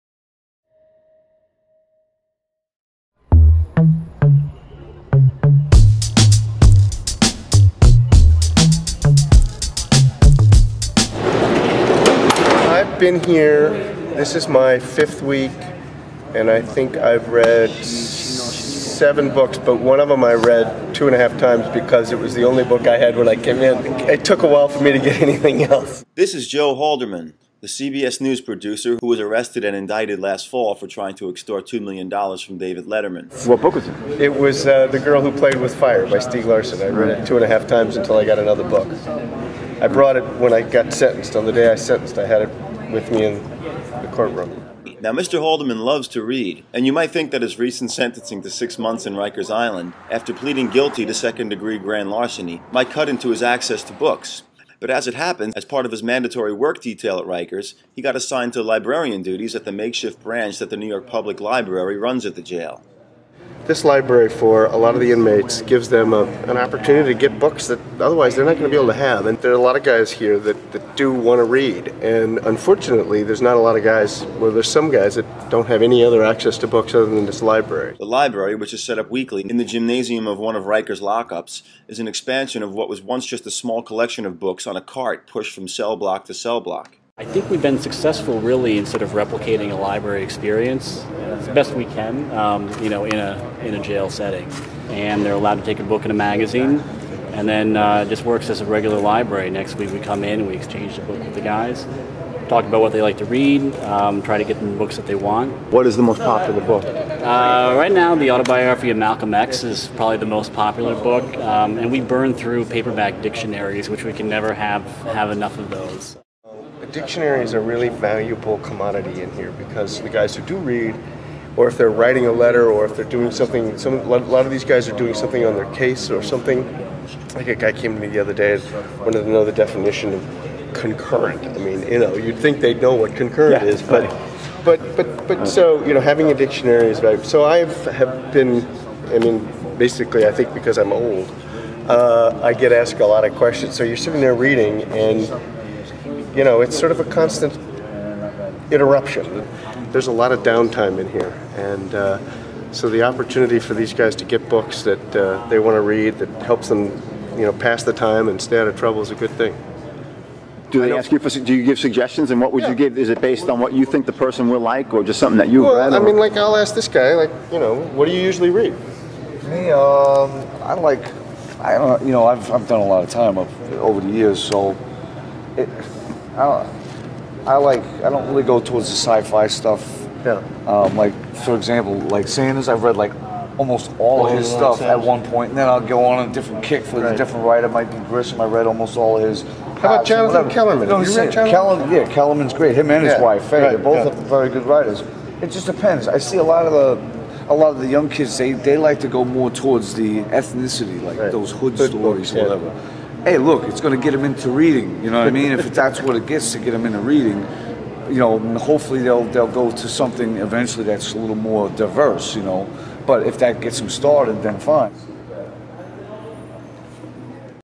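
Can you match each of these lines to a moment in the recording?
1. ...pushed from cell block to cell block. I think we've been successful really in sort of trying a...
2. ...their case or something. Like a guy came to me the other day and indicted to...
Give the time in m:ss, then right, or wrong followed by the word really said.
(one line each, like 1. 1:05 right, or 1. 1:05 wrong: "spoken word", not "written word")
1. 1:25 wrong: "replicating", not "trying"
2. 2:05 wrong: "wanted", not "indicted".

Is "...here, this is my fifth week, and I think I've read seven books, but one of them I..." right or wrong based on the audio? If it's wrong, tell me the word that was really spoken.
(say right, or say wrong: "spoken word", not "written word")
right.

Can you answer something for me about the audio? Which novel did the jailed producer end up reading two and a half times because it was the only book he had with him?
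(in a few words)
The Girl Who Played with Fire.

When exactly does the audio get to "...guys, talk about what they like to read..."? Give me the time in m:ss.
1:41.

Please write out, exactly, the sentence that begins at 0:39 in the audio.
I brought it when I got sentenced.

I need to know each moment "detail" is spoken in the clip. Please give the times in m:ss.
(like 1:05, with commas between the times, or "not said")
0:56.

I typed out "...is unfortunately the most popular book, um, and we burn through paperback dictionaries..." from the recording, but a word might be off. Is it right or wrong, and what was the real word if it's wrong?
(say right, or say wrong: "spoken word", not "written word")
wrong: "probably", not "unfortunately".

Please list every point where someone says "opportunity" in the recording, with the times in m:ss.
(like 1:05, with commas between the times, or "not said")
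1:06, 2:33.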